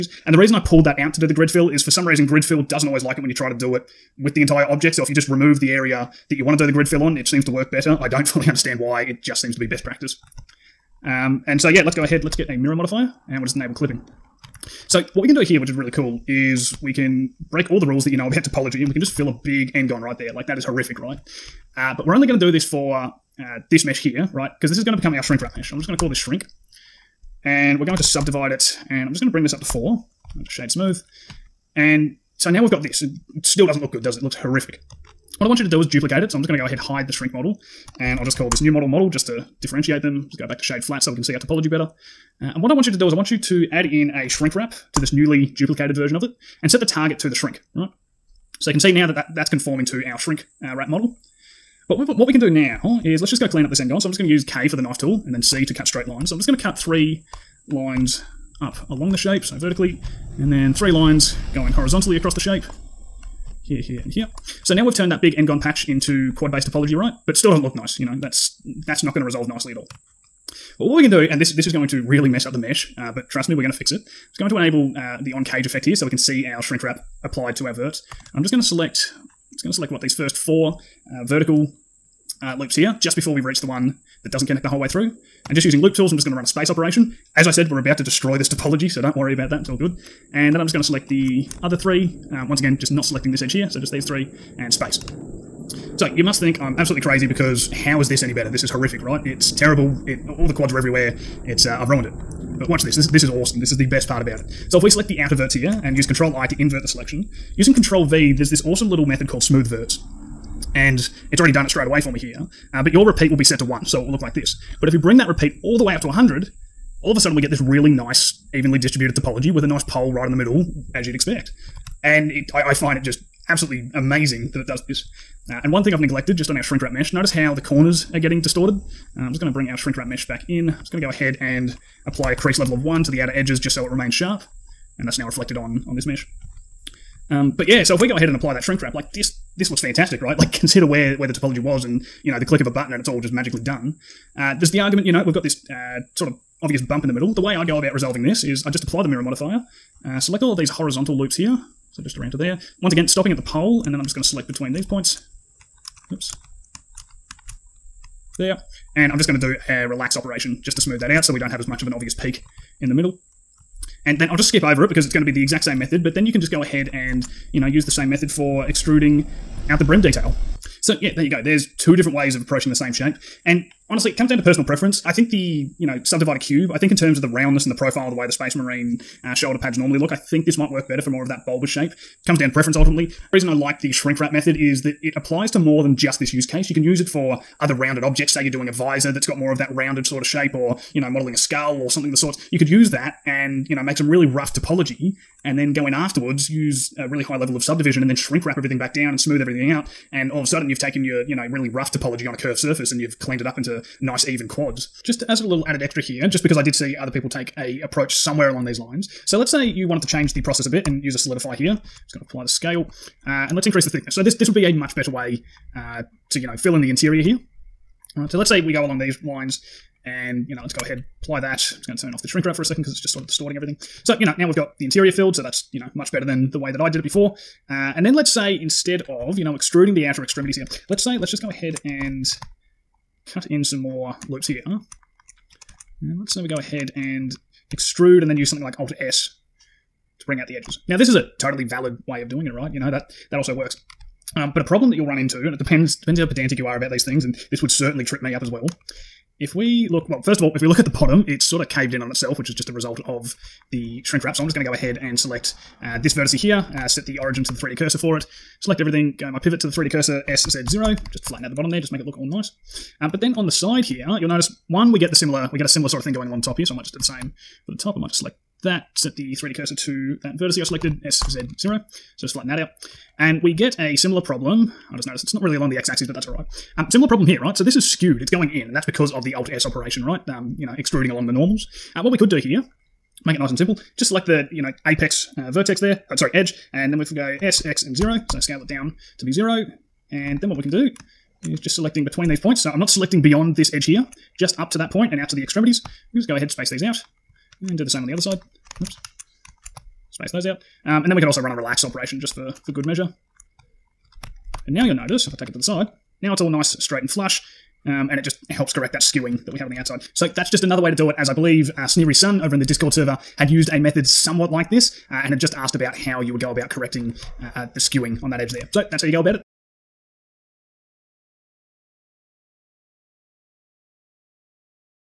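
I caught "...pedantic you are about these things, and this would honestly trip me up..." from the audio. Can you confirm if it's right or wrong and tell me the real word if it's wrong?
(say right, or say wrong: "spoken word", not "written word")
wrong: "certainly", not "honestly".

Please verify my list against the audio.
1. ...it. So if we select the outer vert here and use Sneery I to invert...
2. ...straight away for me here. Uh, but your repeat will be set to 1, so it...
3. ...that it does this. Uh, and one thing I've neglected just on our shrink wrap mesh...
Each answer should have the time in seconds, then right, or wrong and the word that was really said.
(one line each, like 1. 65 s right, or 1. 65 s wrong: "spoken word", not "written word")
1. 104 s wrong: "Control", not "Sneery"
2. 111 s right
3. 124 s right.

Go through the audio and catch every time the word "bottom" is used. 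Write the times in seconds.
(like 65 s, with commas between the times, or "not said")
250 s, 261 s.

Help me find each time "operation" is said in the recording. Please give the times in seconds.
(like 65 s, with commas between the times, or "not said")
86 s, 160 s, 279 s, 301 s.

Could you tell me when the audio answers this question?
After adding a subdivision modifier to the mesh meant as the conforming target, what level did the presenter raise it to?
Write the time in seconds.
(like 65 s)
29 s.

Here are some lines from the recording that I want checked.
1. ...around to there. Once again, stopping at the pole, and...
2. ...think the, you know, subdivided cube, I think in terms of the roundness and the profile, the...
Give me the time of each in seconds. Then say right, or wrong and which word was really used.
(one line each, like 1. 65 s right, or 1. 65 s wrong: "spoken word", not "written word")
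1. 152 s right
2. 175 s right.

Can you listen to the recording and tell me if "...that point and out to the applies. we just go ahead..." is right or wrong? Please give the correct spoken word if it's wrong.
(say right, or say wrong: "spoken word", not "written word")
wrong: "extremities", not "applies".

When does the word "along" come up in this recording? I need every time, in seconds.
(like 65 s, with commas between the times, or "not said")
58 s, 208 s, 218 s, 266 s, 275 s, 281 s.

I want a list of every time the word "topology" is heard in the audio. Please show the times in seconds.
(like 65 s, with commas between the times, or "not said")
18 s, 41 s, 66 s, 88 s, 119 s, 141 s, 194 s, 201 s.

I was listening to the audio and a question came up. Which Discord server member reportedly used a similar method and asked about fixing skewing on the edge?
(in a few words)
Sneery Sun.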